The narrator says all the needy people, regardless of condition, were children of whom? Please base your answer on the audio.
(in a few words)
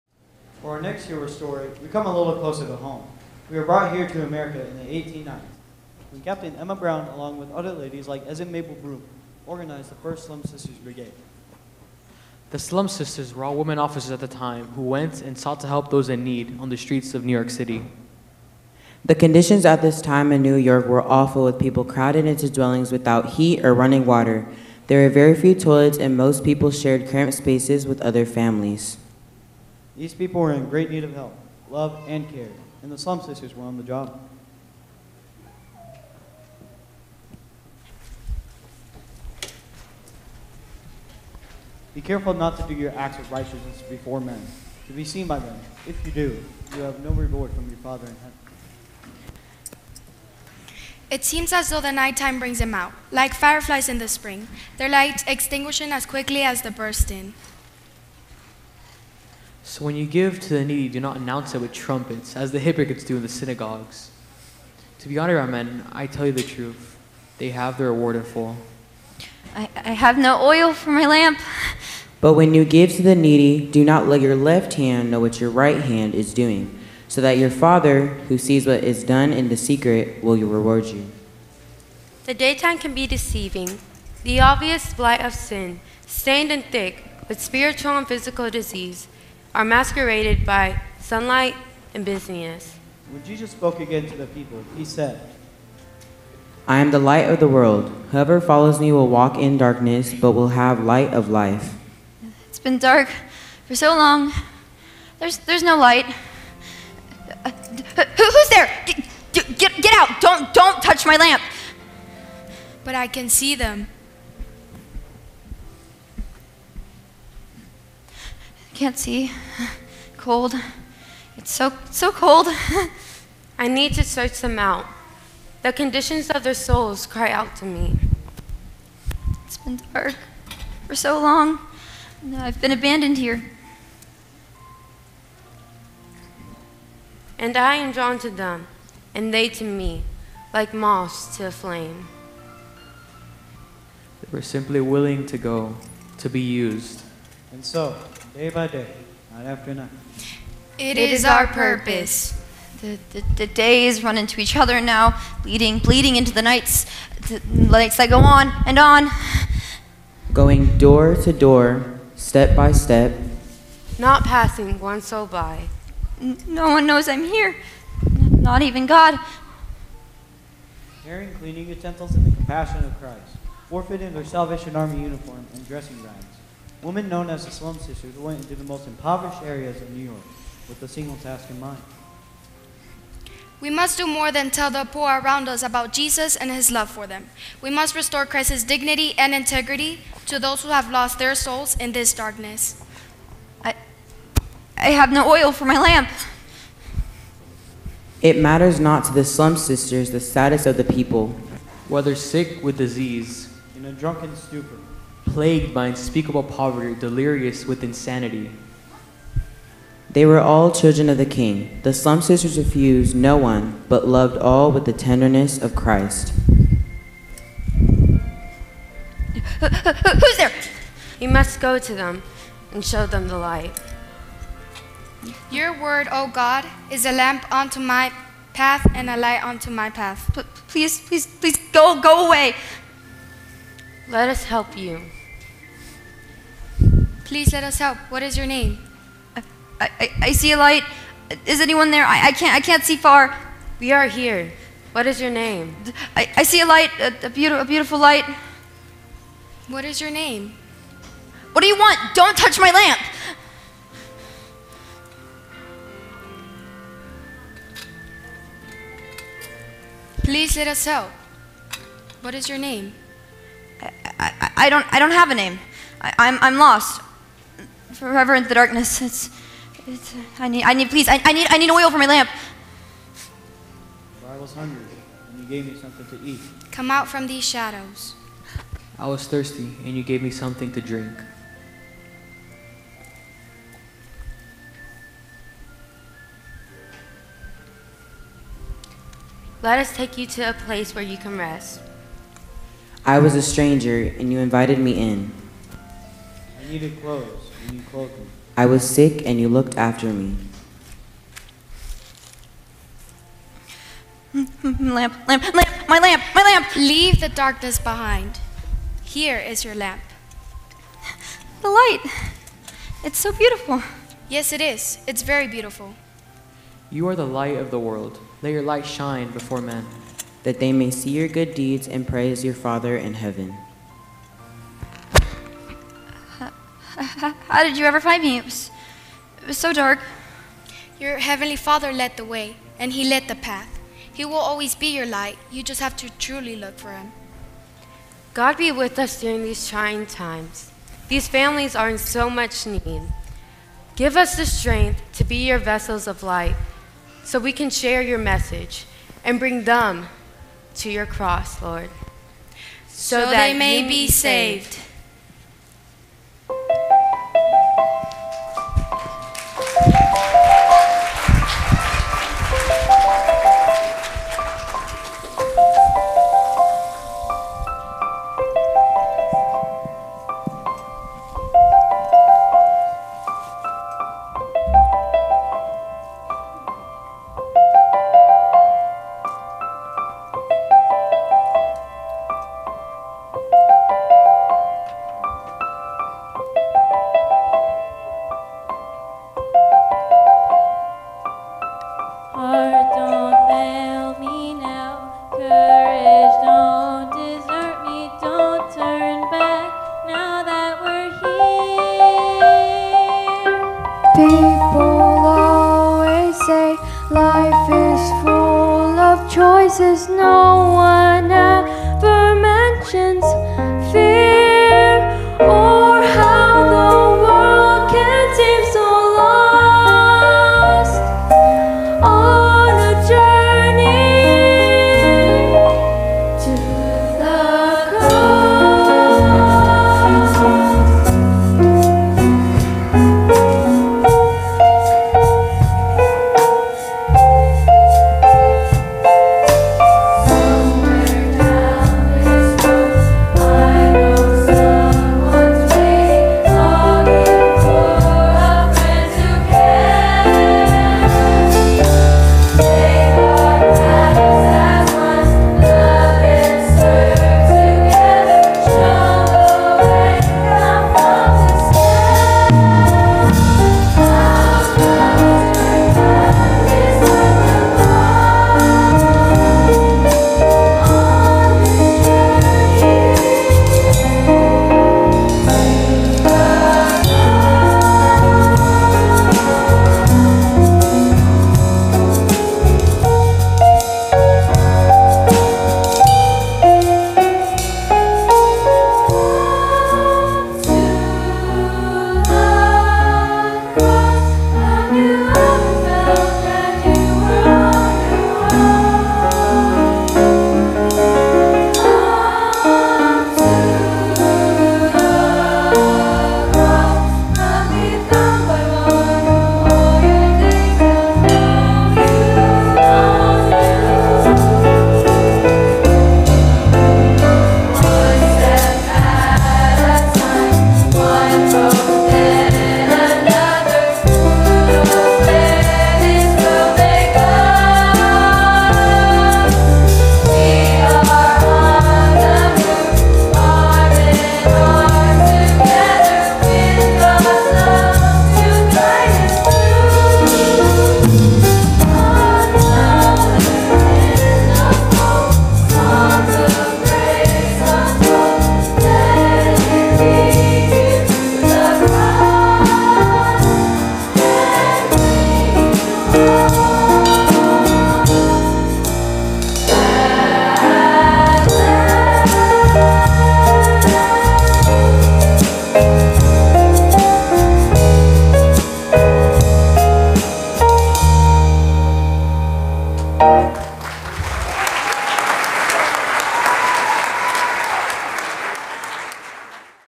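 the King.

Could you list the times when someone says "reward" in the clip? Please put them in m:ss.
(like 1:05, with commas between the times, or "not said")
0:47, 1:07, 1:20.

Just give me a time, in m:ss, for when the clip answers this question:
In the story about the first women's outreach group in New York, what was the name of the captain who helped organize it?
0:06.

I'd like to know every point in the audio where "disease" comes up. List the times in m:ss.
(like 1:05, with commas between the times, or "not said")
1:28, 3:22.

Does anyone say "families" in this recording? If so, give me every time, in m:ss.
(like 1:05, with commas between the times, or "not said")
0:28, 5:41.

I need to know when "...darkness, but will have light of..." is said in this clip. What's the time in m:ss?
1:39.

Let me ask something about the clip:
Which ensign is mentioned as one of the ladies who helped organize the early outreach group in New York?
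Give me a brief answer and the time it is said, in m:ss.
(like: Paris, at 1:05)
Mabel Broom, at 0:08.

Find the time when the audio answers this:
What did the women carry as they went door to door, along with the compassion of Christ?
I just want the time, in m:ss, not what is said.
2:51.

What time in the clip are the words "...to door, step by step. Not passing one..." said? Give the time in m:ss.
2:41.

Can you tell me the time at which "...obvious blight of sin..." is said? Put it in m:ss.
1:24.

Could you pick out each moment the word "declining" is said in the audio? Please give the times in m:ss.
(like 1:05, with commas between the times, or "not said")
not said.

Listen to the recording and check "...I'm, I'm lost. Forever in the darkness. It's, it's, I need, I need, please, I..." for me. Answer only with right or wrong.
right.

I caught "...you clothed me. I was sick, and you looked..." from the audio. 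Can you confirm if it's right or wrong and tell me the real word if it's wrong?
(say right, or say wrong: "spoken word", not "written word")
right.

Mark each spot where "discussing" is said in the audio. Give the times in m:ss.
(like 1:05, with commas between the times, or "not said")
not said.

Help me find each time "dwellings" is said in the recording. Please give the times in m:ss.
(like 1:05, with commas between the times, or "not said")
0:22.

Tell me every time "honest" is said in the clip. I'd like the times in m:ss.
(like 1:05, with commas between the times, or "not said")
1:05.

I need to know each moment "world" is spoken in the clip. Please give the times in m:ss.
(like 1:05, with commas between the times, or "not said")
1:37, 5:17.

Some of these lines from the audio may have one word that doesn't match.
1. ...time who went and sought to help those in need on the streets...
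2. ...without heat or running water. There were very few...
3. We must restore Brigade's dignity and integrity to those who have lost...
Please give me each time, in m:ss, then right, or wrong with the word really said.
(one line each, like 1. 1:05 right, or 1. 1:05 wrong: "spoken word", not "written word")
1. 0:14 right
2. 0:22 right
3. 3:07 wrong: "Christ", not "Brigade".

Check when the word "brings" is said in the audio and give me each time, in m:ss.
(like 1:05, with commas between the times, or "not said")
0:52, 5:49.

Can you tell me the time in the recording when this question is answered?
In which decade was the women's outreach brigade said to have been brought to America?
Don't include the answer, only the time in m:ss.
0:04.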